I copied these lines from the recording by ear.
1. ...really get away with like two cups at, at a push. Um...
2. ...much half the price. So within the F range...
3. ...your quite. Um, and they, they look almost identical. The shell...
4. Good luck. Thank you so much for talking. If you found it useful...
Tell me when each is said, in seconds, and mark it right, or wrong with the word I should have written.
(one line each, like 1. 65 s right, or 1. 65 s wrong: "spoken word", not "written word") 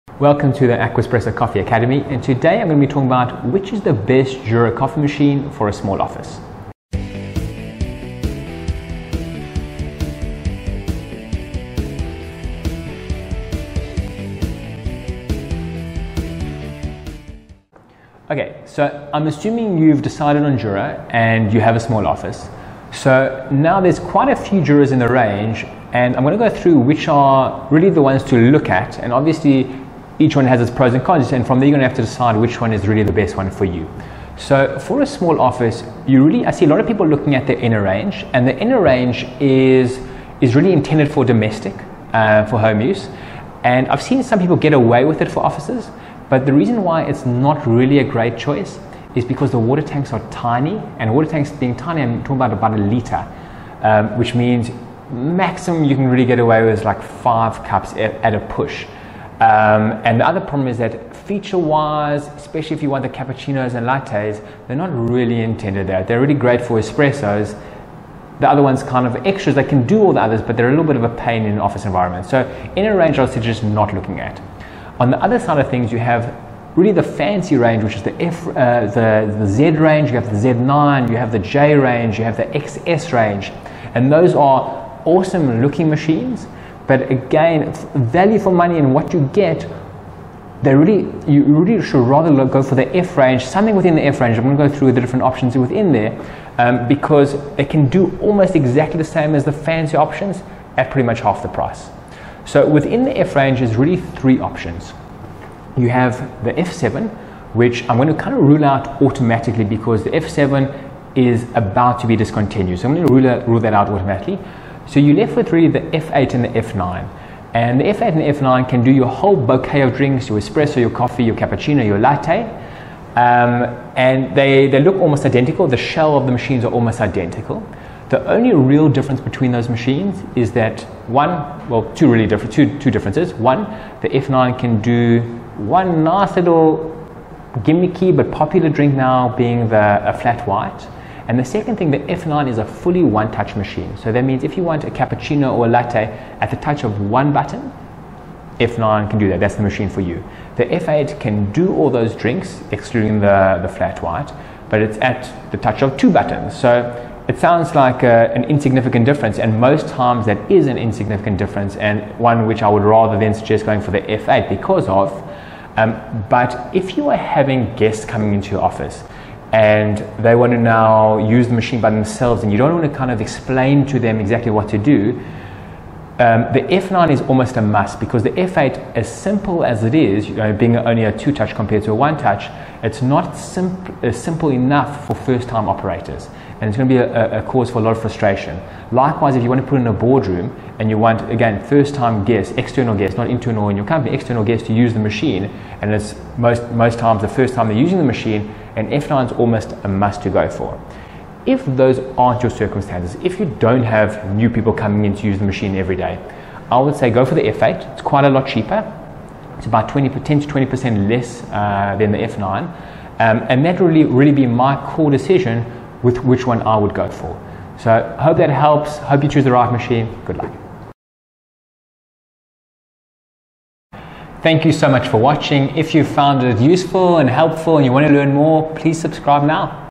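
1. 56 s wrong: "five", not "two"
2. 101 s right
3. 121 s wrong: "latte", not "quite"
4. 220 s wrong: "watching", not "talking".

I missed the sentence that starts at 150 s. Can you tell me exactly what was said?
The F8 can do all those drinks, excluding the, the flat white, but it's at the touch of two buttons.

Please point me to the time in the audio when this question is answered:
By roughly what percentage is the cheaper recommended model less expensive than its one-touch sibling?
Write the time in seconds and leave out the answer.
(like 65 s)
210 s.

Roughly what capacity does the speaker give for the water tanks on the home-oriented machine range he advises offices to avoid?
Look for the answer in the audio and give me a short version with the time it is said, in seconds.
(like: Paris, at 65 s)
about 1 liter, at 52 s.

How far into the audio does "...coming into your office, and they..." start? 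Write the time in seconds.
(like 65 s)
168 s.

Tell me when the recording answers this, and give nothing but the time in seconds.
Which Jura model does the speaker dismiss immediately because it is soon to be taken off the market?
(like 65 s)
106 s.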